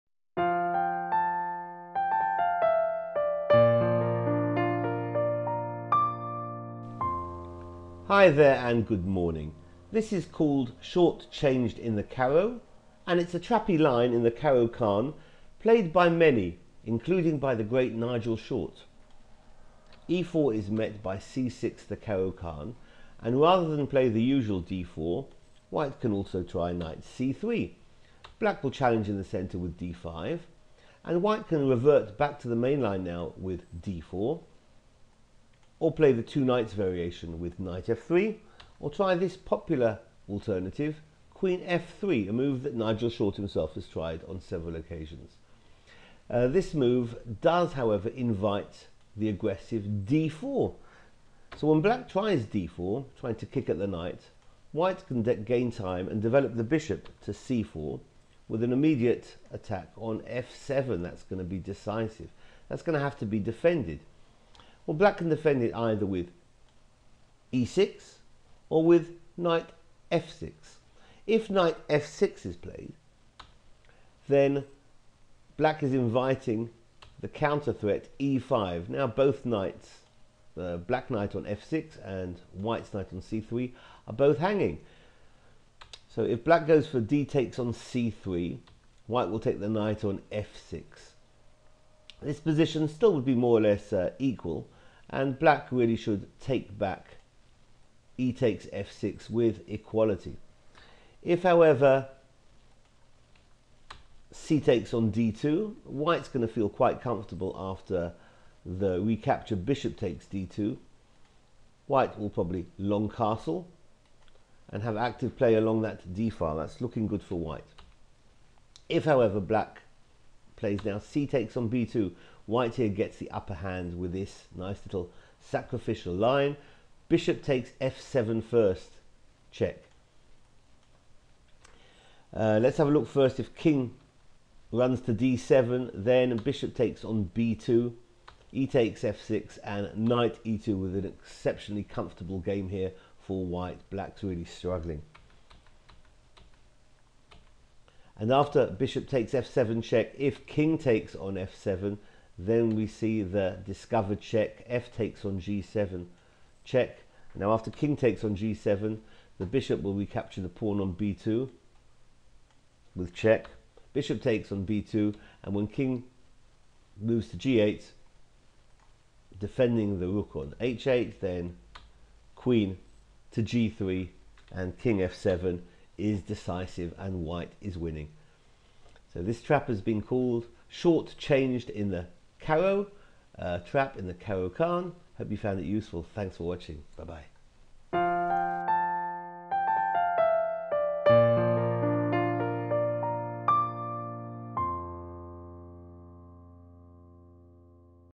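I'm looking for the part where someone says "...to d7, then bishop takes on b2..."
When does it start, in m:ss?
2:15.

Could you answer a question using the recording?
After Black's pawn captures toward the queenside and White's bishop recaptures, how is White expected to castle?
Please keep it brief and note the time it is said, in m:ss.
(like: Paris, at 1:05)
long castle, at 1:52.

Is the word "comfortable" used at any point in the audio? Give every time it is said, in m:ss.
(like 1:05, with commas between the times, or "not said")
1:47, 2:21.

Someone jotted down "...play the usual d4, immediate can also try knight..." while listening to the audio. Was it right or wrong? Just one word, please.
wrong.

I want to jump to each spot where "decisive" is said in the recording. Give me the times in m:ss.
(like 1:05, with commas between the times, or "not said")
1:01, 2:56.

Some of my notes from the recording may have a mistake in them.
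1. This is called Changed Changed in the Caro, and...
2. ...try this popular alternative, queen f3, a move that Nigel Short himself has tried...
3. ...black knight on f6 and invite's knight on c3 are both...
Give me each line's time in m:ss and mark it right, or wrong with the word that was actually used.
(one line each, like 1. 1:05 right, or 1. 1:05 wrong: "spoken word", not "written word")
1. 0:09 wrong: "Short", not "Changed"
2. 0:38 right
3. 1:20 wrong: "white", not "invite".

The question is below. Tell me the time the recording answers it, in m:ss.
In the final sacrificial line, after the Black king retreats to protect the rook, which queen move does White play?
2:52.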